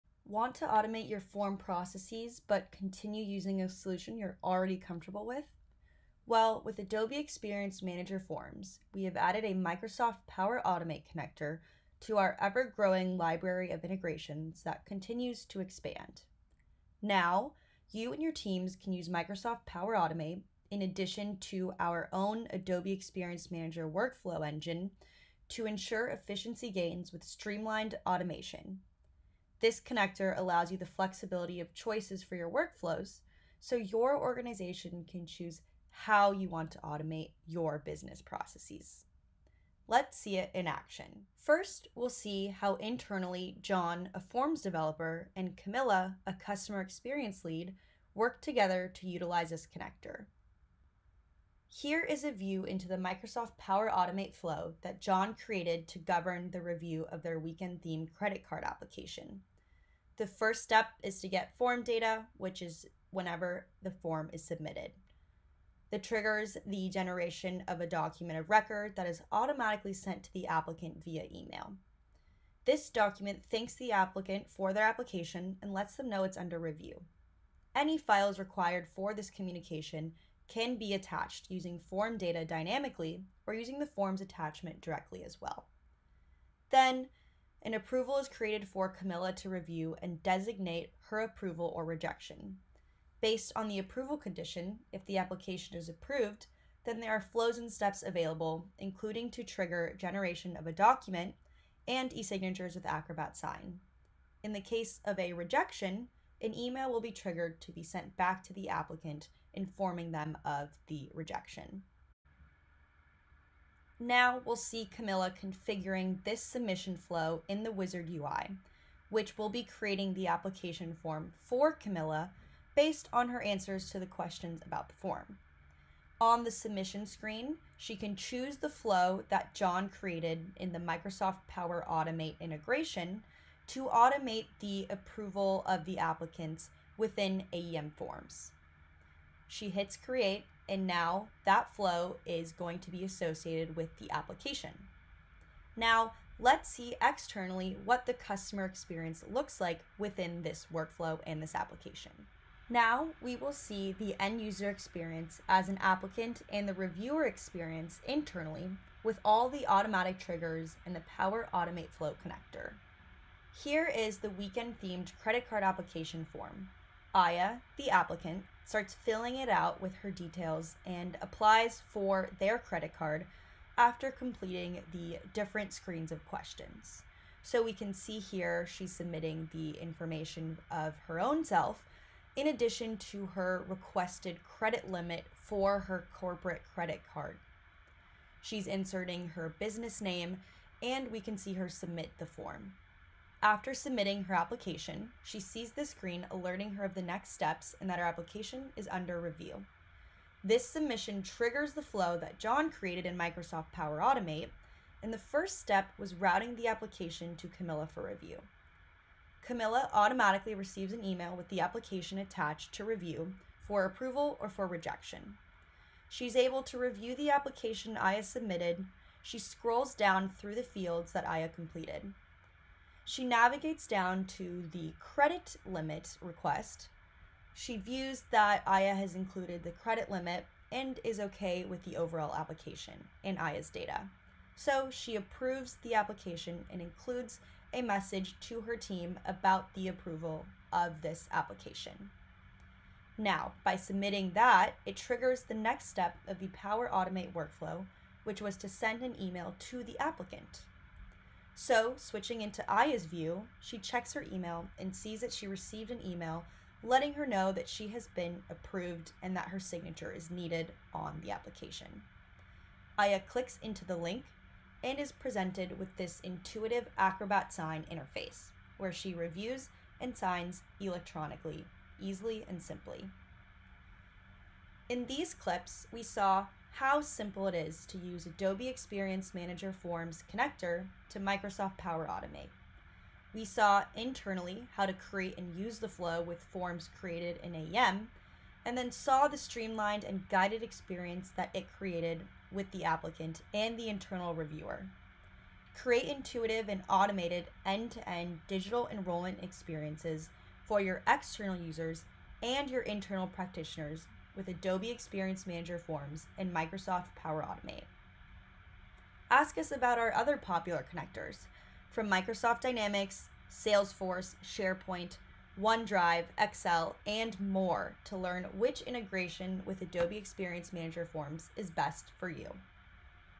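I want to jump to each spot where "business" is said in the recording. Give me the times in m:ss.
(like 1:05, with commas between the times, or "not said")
0:37, 3:09.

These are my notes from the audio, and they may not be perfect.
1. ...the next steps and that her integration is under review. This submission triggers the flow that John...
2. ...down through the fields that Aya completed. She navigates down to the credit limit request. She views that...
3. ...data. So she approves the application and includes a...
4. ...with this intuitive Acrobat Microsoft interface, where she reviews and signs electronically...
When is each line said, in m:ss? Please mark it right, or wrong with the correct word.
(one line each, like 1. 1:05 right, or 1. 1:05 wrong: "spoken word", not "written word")
1. 3:16 wrong: "application", not "integration"
2. 3:39 right
3. 3:53 right
4. 4:25 wrong: "Sign", not "Microsoft".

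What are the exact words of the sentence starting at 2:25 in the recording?
Now, let's see externally what the customer experience looks like within this workflow and this application.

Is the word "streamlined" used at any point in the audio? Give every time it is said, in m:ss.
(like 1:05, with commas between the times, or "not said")
0:27, 4:49.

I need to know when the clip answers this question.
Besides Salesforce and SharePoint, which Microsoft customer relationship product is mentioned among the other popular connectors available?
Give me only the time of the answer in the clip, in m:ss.
5:12.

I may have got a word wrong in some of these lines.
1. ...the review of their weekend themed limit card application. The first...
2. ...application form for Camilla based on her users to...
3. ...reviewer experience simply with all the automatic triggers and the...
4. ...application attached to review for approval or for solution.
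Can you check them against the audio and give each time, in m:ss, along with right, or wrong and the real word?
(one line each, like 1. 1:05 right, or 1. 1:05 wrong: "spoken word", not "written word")
1. 0:56 wrong: "credit", not "limit"
2. 2:00 wrong: "answers", not "users"
3. 2:36 wrong: "internally", not "simply"
4. 3:31 wrong: "rejection", not "solution".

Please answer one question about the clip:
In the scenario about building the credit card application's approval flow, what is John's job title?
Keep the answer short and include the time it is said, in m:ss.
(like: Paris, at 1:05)
Forms developer, at 0:44.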